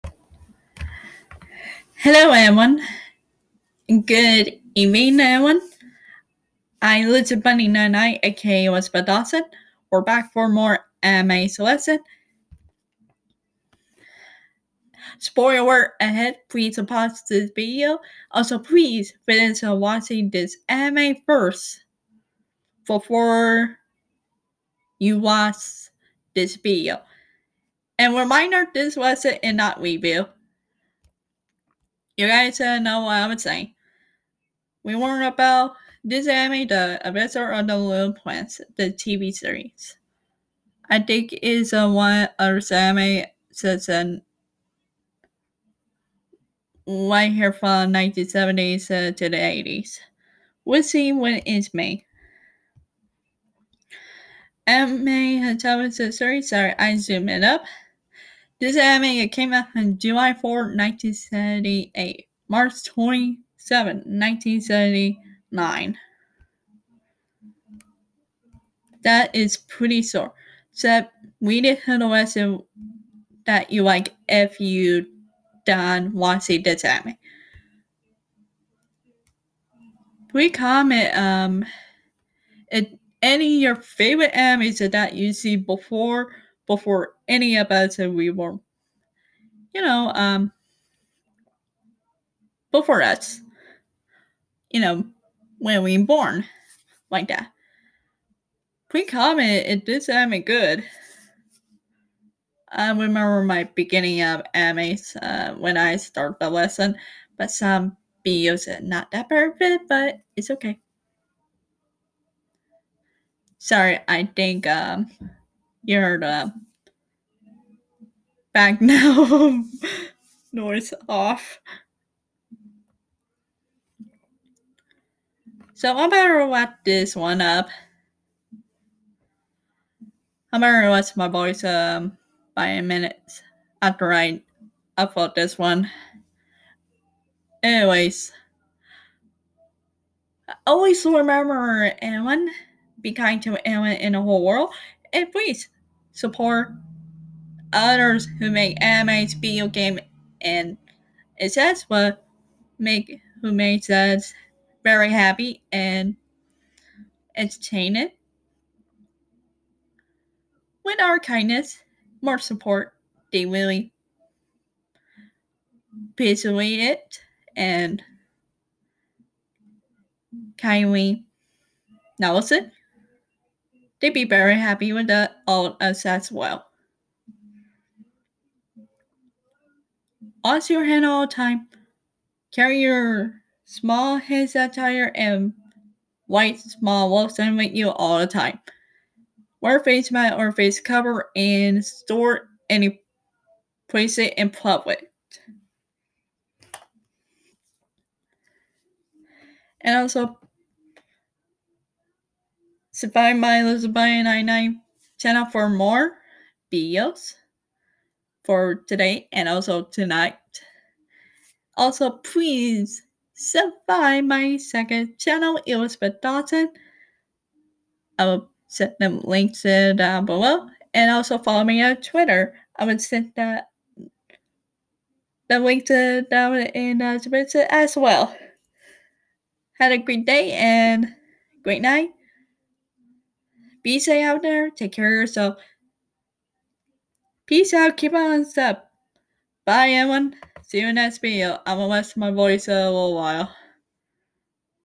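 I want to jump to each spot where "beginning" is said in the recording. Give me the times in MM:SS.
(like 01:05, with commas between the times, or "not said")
01:43.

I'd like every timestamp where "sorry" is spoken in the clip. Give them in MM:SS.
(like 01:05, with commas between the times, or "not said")
00:56, 01:53.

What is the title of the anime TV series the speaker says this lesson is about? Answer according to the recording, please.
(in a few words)
The Adventure of the Little Prince.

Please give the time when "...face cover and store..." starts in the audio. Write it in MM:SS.
03:10.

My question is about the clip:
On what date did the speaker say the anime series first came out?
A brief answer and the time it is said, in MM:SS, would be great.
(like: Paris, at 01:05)
July 4, 1978, at 00:59.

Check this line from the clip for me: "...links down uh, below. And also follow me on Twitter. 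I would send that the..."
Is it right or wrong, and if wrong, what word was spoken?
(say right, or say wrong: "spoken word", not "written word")
right.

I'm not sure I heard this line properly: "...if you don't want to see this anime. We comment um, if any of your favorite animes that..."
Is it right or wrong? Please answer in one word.
right.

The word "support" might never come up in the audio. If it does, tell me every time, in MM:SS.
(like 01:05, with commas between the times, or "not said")
02:26, 02:42.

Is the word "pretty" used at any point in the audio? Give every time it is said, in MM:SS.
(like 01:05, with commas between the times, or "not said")
01:09, 01:38.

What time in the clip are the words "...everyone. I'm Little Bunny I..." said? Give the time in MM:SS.
00:05.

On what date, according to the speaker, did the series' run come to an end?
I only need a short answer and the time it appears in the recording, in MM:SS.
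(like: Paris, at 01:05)
March 27, 1979, at 01:02.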